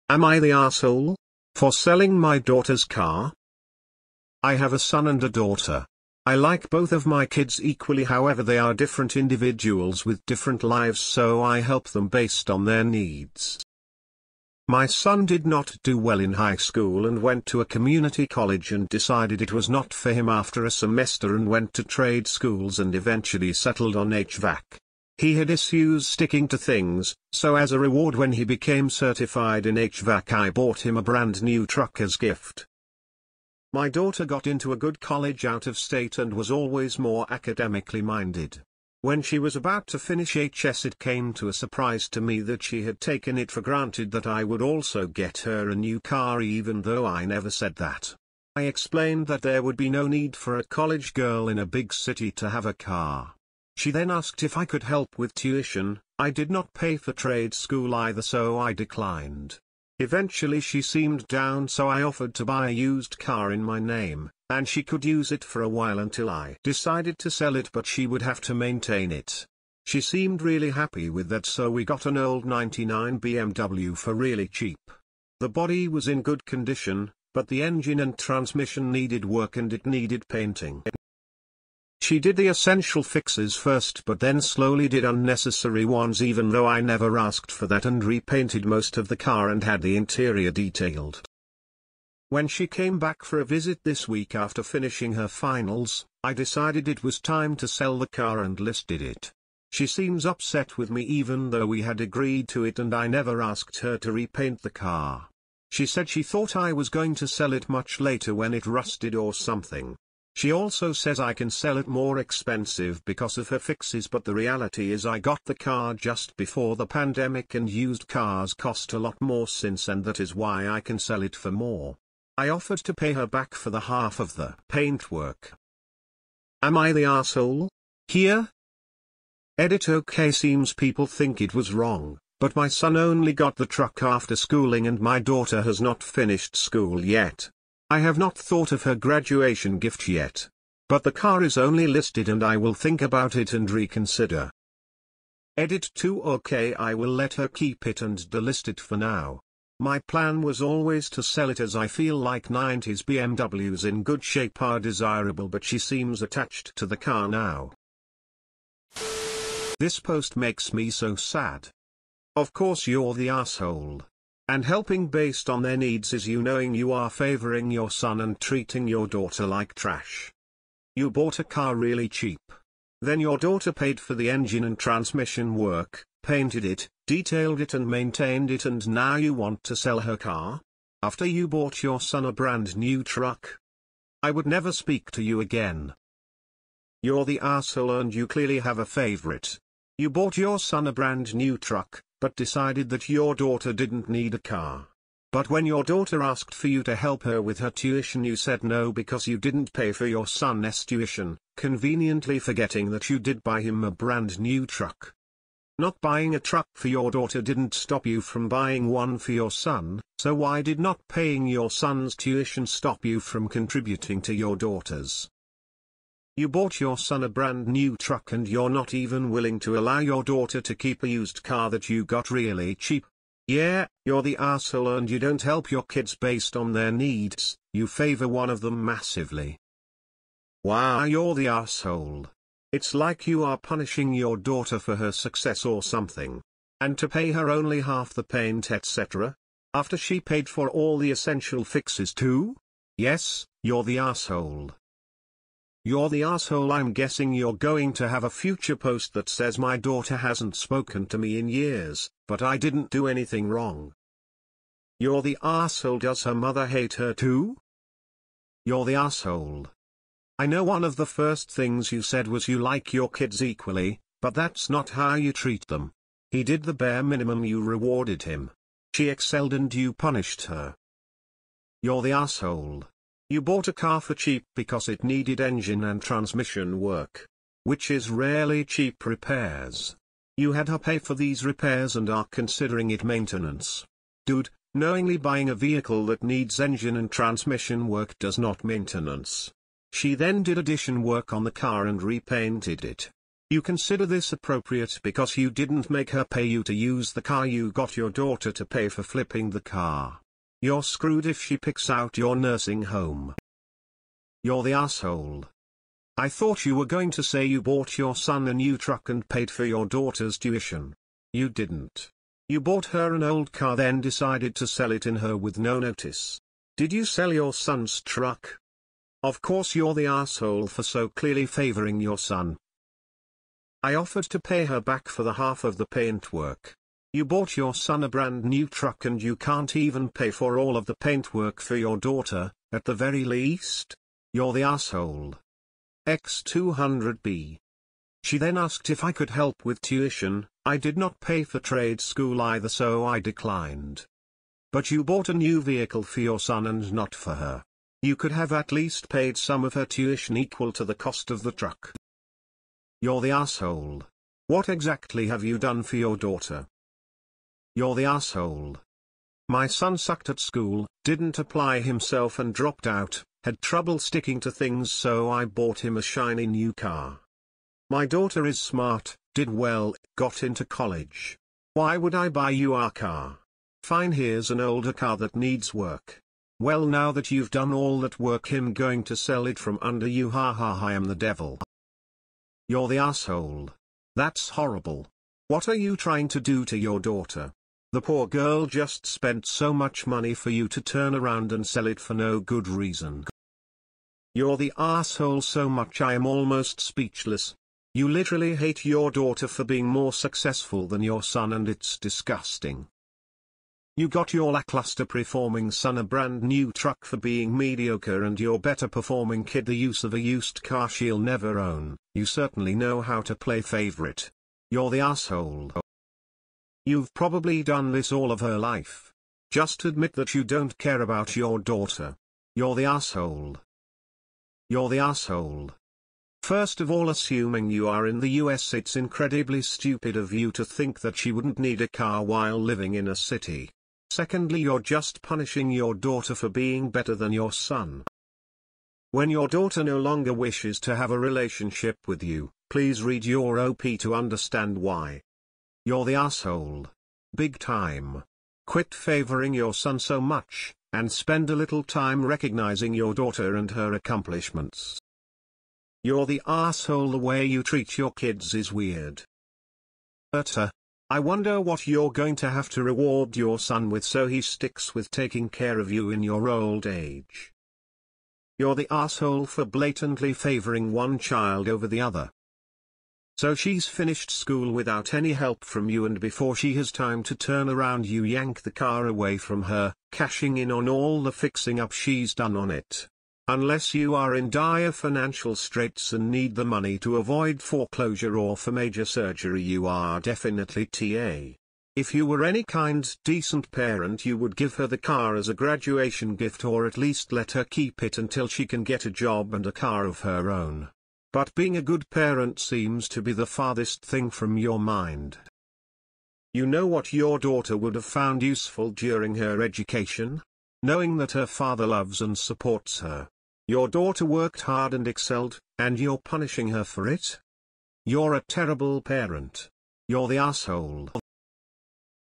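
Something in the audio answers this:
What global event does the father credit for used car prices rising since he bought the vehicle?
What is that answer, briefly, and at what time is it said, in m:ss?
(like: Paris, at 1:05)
the pandemic, at 1:56.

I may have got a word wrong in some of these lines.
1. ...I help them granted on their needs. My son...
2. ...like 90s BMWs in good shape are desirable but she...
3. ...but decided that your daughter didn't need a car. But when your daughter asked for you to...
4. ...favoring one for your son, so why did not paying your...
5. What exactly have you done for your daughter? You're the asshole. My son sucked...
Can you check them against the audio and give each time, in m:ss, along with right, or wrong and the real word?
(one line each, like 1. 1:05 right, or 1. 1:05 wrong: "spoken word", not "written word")
1. 0:11 wrong: "based", not "granted"
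2. 2:32 right
3. 3:12 right
4. 3:28 wrong: "buying", not "favoring"
5. 5:54 right.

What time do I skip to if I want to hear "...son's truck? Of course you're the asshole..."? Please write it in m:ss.
5:17.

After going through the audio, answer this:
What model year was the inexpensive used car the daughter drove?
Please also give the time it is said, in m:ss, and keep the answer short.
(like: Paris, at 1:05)
99, at 1:12.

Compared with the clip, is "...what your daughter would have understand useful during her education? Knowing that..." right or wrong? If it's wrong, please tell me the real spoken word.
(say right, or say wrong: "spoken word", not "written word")
wrong: "found", not "understand".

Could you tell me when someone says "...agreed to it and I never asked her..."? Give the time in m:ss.
1:42.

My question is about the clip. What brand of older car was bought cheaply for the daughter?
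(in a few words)
BMW.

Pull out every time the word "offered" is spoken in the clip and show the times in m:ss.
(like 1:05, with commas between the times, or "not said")
1:02, 2:02, 5:23.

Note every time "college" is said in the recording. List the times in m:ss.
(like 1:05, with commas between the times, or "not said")
0:18, 0:34, 0:50, 6:10.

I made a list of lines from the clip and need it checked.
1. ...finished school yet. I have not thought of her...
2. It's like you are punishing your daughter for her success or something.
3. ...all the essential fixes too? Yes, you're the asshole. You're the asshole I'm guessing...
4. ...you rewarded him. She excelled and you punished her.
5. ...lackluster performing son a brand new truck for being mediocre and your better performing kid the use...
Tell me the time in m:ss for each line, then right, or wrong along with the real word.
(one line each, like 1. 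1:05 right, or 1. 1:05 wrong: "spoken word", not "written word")
1. 2:16 right
2. 3:52 right
3. 4:00 right
4. 4:27 right
5. 6:44 right.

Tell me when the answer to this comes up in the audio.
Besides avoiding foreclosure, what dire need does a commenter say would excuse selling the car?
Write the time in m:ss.
8:08.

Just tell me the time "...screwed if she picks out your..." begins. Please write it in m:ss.
5:00.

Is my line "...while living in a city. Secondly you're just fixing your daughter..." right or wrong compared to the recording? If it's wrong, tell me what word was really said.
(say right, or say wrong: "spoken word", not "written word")
wrong: "punishing", not "fixing".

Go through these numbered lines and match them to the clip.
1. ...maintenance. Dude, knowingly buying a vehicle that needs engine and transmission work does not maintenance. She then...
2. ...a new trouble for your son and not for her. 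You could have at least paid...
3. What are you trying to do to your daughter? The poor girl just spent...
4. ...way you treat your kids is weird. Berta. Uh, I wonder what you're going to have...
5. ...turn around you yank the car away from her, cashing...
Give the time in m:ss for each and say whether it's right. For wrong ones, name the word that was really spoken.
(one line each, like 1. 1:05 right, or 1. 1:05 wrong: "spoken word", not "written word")
1. 4:43 right
2. 5:45 wrong: "vehicle", not "trouble"
3. 6:25 right
4. 7:37 right
5. 7:57 right.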